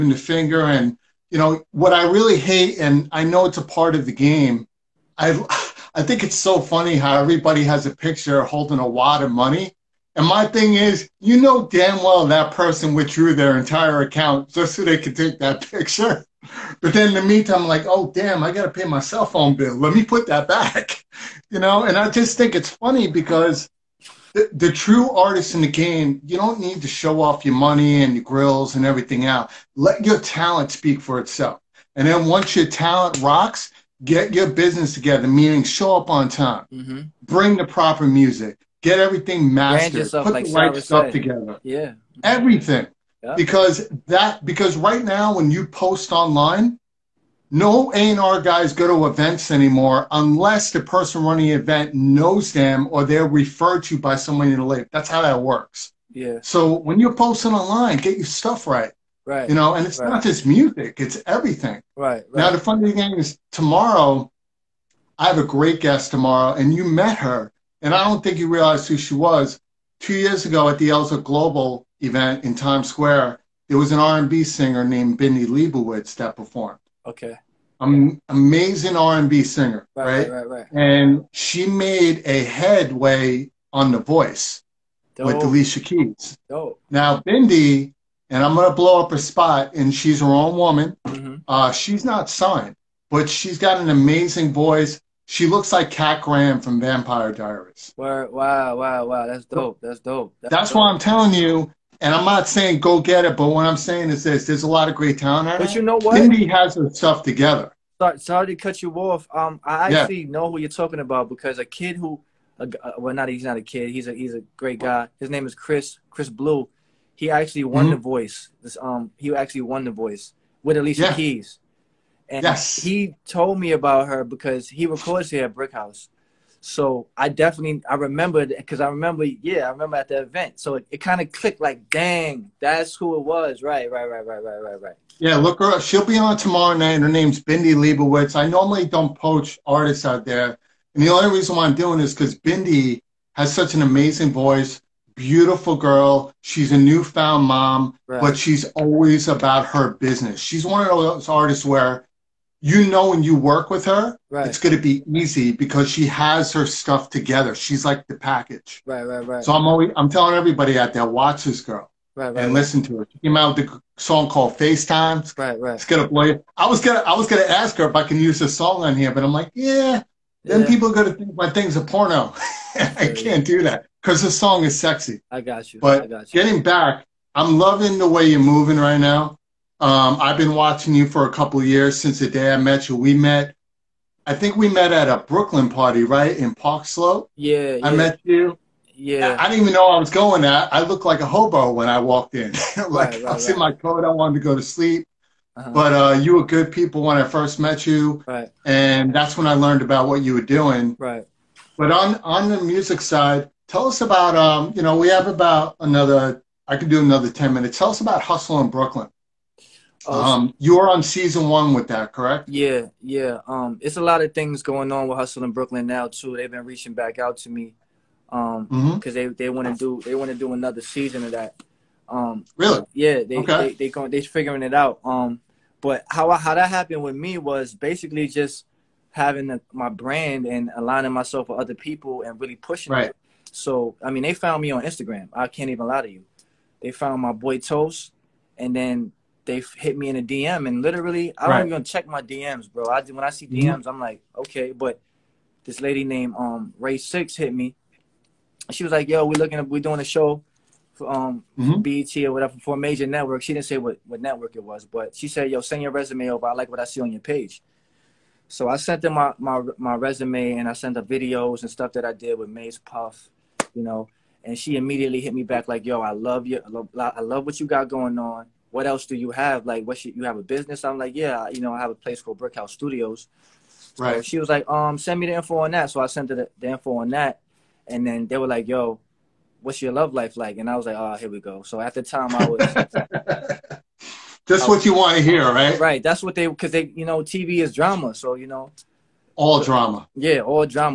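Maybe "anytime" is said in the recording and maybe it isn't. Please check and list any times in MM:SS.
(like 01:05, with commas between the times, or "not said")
not said.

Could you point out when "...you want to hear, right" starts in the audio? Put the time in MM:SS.
04:44.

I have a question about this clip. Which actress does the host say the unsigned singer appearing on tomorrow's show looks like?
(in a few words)
Kat Graham.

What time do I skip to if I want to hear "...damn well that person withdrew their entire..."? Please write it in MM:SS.
00:11.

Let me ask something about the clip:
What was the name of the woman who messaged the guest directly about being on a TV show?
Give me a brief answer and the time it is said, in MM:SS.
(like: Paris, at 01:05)
Ray Six, at 04:06.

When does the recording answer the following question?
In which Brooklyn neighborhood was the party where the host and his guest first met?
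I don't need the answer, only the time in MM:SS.
03:06.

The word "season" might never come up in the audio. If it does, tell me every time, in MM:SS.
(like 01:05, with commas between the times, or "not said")
03:31, 03:40.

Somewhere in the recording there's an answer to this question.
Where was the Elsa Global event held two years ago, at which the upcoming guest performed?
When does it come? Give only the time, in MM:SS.
01:12.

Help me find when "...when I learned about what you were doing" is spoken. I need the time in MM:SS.
03:19.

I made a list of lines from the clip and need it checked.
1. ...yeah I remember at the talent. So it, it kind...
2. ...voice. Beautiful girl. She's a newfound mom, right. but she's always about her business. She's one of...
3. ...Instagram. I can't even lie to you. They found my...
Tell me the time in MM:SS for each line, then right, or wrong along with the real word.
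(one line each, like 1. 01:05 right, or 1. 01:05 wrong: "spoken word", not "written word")
1. 02:09 wrong: "event", not "talent"
2. 02:24 right
3. 03:54 right.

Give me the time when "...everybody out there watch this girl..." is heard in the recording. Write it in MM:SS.
02:40.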